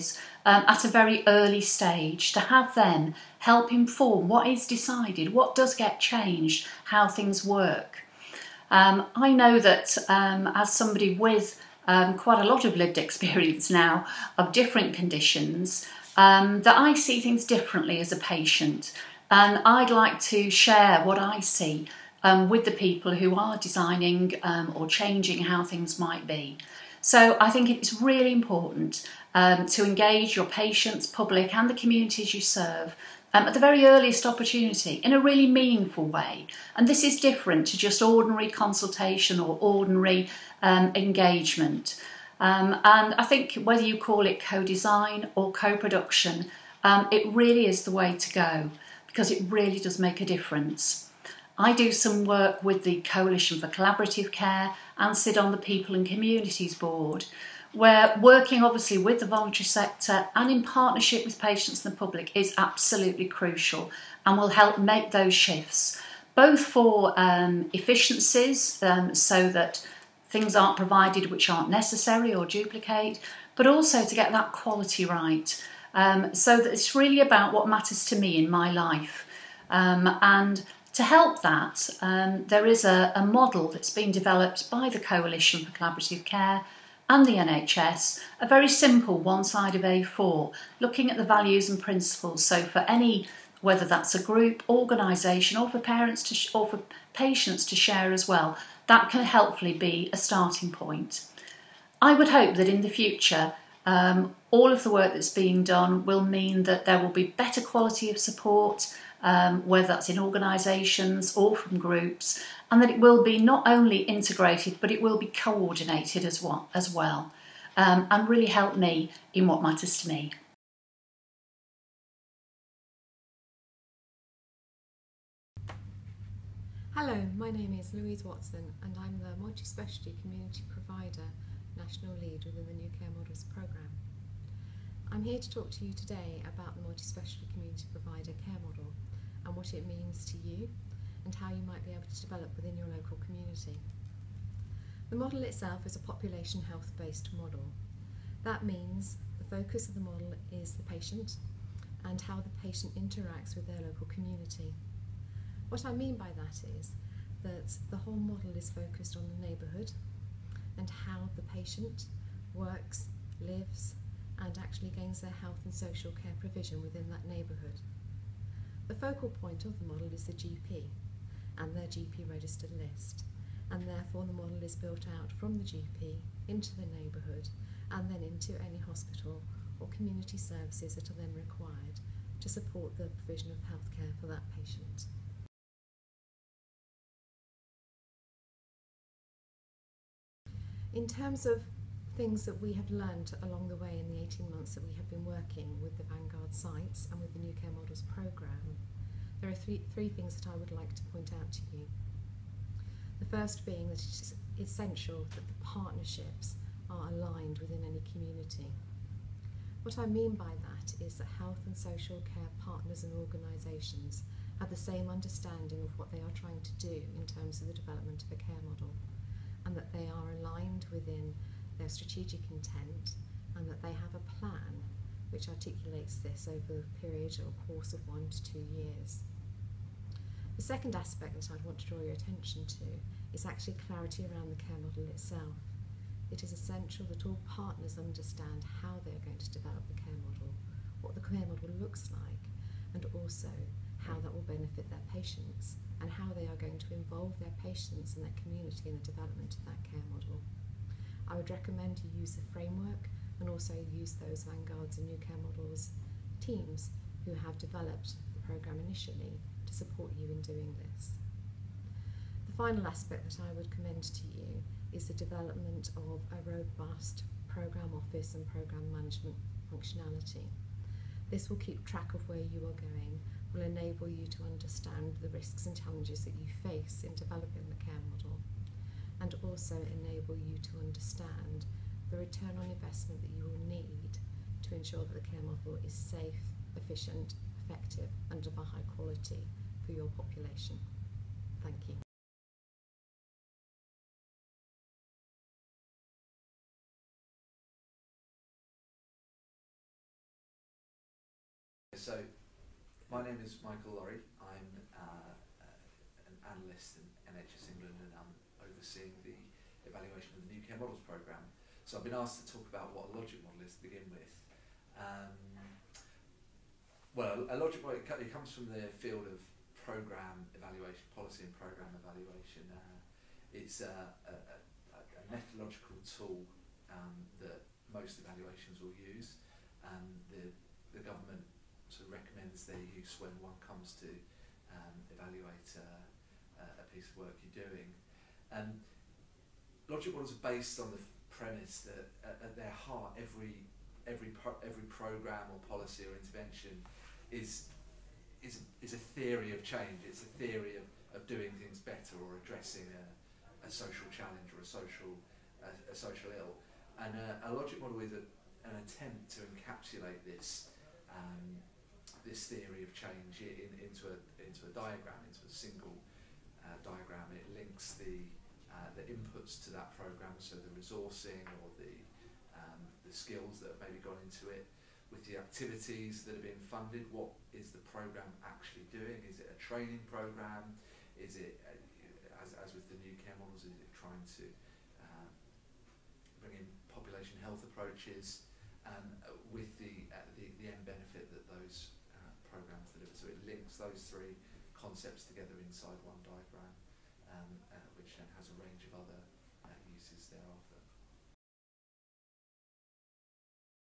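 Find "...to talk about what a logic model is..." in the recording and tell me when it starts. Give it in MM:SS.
05:12.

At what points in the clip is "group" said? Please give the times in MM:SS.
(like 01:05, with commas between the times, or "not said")
01:34, 01:51.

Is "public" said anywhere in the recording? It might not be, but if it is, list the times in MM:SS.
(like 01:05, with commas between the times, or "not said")
00:31, 01:01.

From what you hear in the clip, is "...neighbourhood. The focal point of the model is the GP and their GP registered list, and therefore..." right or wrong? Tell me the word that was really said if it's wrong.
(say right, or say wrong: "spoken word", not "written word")
right.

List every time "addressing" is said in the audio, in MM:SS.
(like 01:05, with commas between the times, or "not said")
05:52.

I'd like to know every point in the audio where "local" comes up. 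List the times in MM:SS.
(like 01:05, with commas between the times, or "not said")
02:22, 02:33.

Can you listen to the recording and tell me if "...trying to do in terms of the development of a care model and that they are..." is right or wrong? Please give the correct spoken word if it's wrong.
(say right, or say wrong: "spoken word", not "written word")
right.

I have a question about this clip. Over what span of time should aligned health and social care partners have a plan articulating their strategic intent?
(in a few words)
one to two years.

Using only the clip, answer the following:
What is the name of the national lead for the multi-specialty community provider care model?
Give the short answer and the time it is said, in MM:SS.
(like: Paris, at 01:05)
Louise Watson, at 02:07.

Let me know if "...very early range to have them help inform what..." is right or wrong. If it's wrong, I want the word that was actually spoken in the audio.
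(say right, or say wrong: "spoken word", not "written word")
wrong: "stage", not "range".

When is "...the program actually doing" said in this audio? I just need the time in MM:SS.
06:17.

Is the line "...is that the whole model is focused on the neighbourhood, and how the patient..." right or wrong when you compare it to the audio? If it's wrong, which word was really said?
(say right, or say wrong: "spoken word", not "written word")
right.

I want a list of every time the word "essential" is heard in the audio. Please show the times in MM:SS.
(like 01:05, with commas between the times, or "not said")
03:24, 03:56.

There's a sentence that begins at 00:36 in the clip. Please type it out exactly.
And this is different to just ordinary consultation or ordinary um, engagement.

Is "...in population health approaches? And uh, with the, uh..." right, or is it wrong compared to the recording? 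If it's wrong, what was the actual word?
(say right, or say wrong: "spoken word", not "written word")
right.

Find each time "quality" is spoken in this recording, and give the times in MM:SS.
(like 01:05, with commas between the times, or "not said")
01:14, 01:47, 04:48.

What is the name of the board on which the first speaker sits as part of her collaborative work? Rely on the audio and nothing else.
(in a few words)
People and Communities Board.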